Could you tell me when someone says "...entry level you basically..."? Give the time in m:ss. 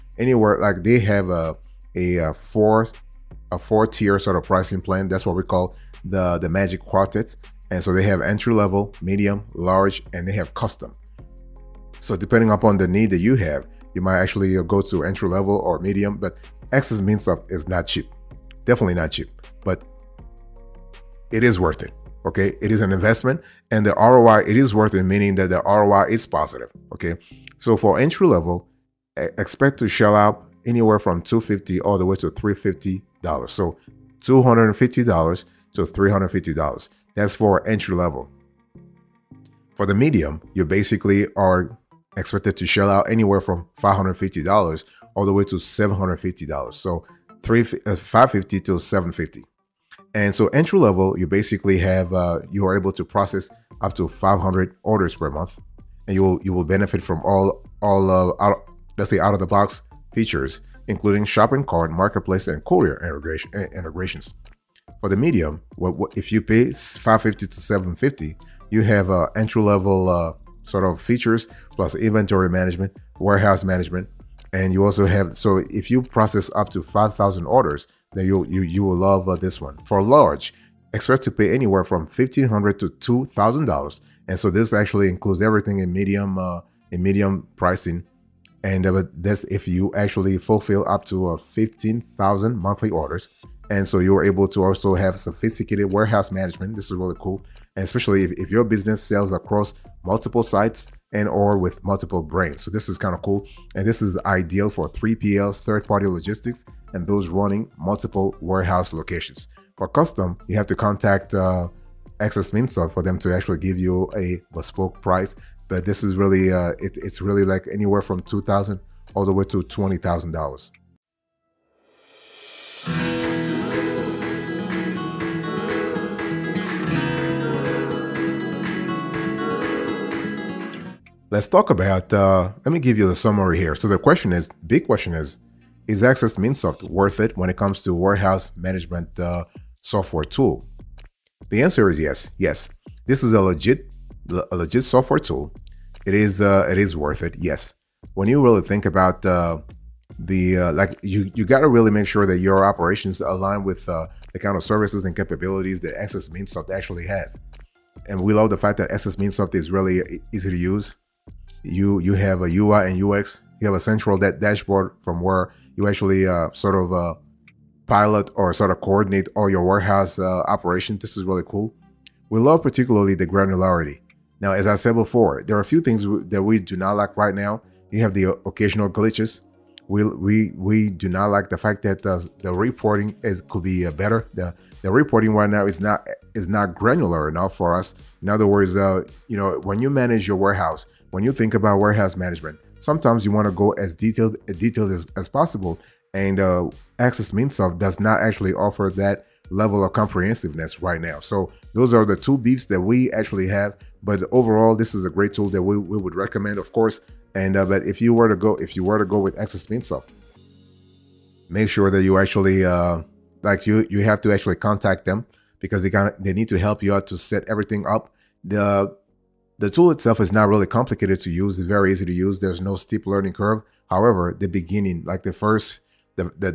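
0:50.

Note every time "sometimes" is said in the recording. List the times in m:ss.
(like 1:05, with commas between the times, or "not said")
3:12.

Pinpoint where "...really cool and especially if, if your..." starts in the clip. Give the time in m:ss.
1:36.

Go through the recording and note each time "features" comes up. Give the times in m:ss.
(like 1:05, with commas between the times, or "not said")
1:00, 1:11.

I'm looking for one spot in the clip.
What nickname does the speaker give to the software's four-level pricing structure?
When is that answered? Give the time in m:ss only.
0:06.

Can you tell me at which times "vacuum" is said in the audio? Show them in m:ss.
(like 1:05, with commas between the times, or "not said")
not said.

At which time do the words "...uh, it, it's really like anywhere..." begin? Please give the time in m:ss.
1:56.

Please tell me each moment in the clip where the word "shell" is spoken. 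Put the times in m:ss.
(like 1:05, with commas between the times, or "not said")
0:29, 0:42.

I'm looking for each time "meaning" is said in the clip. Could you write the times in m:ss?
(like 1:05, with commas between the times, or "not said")
0:25.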